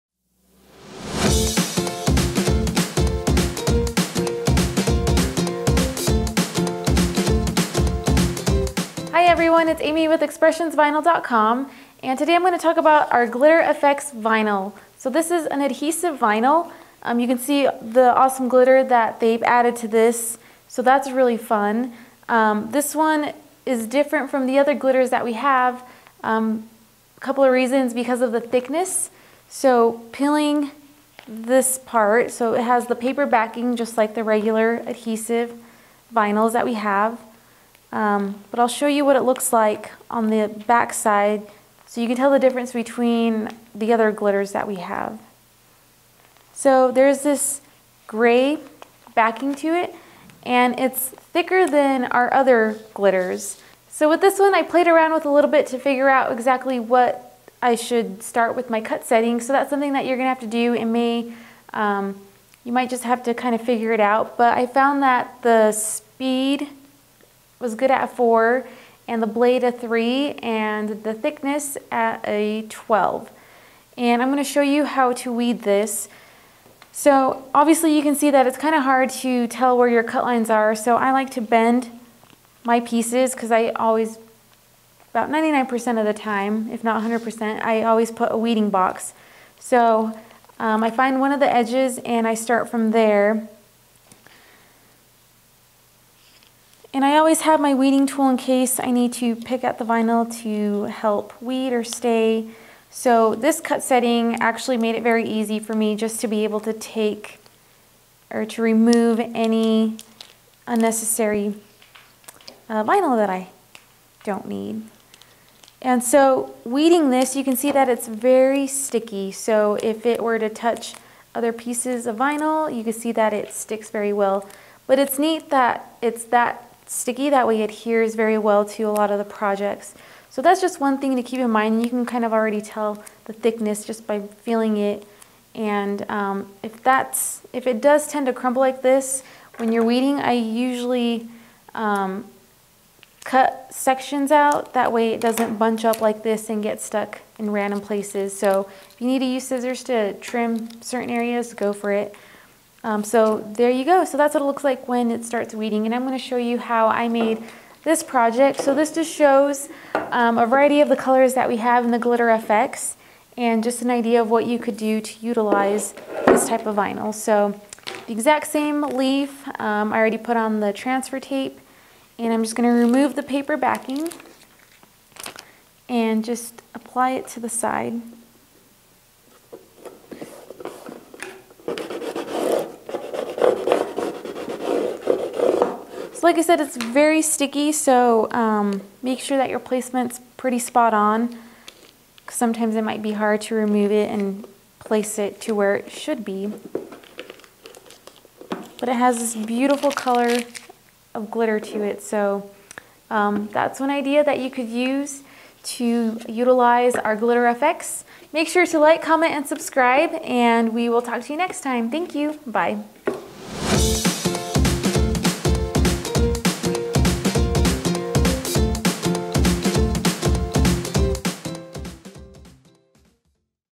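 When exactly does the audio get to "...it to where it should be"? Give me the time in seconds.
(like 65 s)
195 s.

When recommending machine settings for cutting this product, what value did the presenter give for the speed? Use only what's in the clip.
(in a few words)
4.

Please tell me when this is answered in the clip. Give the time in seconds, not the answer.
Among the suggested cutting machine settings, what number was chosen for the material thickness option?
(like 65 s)
72 s.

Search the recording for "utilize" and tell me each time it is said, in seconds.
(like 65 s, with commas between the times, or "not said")
165 s, 206 s.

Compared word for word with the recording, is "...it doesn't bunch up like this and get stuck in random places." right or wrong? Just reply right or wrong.
right.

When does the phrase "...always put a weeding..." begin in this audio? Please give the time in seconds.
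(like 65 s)
87 s.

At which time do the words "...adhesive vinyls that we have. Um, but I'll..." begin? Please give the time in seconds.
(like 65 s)
34 s.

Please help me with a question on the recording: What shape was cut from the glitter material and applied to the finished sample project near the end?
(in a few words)
Leaf.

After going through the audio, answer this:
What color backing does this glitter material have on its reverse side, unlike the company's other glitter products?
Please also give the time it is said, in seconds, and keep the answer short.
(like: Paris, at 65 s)
Gray, at 48 s.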